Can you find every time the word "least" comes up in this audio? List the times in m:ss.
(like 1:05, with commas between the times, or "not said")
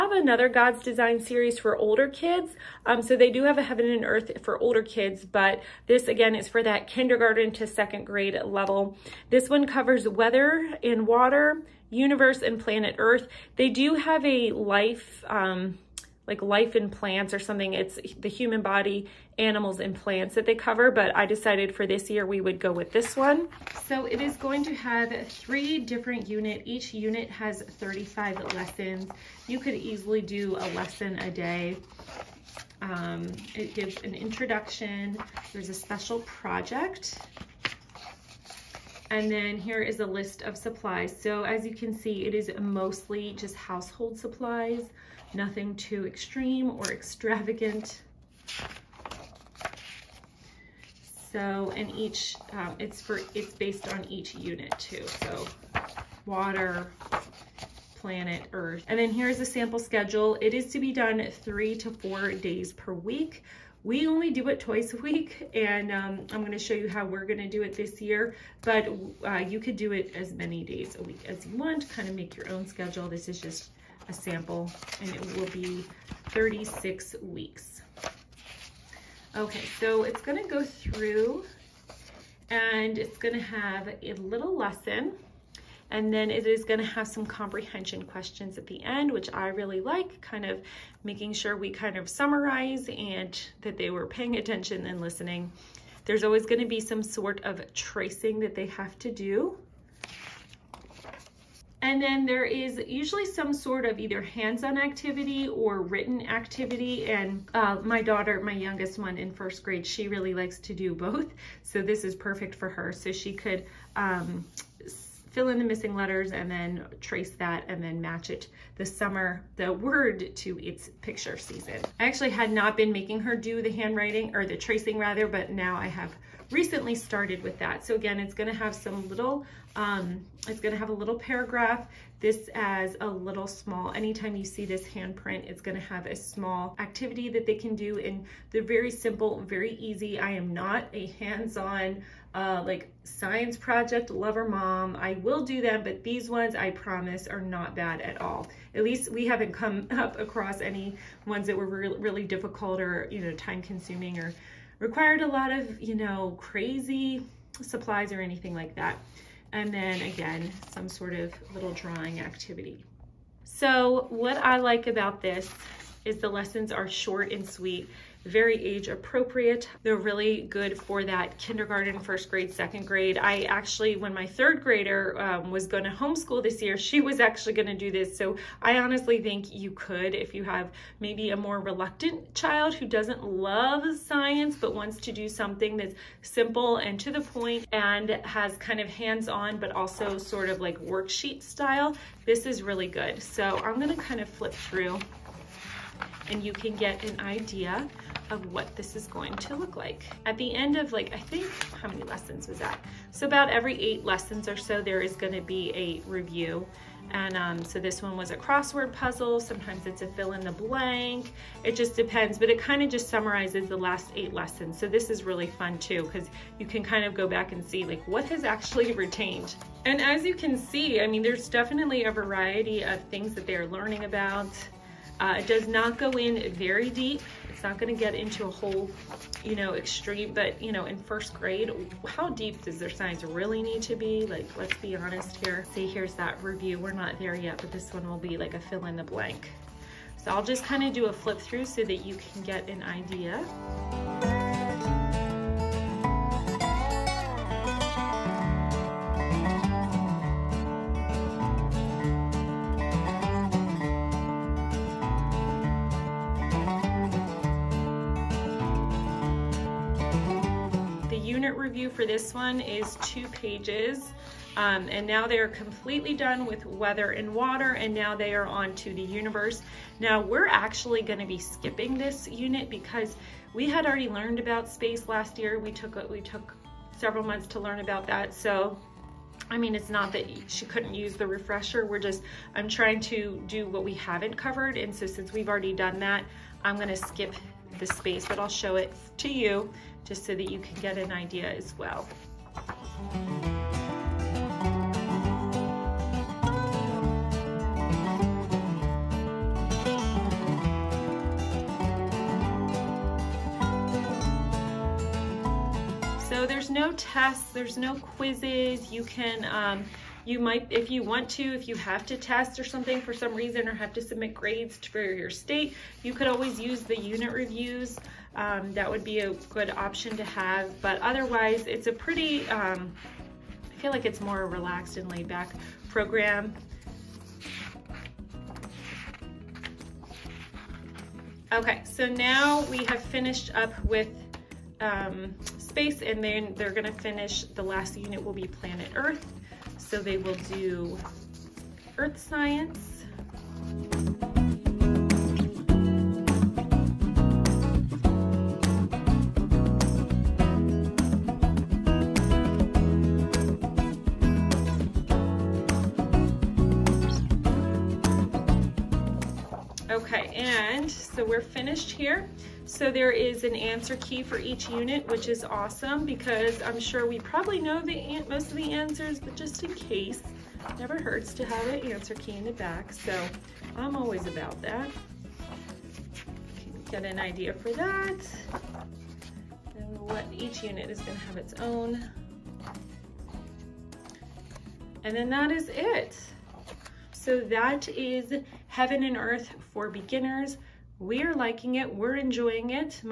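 2:28.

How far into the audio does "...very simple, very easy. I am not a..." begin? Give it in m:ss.
2:18.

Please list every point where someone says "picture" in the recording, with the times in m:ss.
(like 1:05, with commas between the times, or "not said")
2:01.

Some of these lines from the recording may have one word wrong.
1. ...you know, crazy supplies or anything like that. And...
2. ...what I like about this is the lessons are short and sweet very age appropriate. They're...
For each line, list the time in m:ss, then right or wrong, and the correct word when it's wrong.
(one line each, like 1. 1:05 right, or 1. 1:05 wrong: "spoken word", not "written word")
1. 2:35 right
2. 2:44 right.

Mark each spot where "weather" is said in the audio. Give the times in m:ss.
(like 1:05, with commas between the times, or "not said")
0:10, 4:26.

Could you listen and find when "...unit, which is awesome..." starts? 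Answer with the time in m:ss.
6:04.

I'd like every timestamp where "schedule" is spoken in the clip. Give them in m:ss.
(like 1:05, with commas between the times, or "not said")
0:59, 1:12.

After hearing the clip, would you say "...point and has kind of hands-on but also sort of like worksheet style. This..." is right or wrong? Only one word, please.
right.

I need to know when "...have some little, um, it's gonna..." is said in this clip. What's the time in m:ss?
2:08.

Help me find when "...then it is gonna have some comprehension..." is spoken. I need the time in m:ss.
1:26.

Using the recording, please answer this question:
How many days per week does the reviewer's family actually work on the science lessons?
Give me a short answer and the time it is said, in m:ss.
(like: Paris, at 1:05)
Twice, at 1:04.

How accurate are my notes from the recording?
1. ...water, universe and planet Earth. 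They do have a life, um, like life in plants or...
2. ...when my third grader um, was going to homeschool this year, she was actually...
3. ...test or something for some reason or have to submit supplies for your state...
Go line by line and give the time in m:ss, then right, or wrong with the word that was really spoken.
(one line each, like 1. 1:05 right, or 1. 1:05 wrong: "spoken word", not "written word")
1. 0:11 right
2. 2:53 right
3. 5:12 wrong: "grades", not "supplies".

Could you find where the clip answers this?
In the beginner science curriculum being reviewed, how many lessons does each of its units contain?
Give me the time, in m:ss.
0:27.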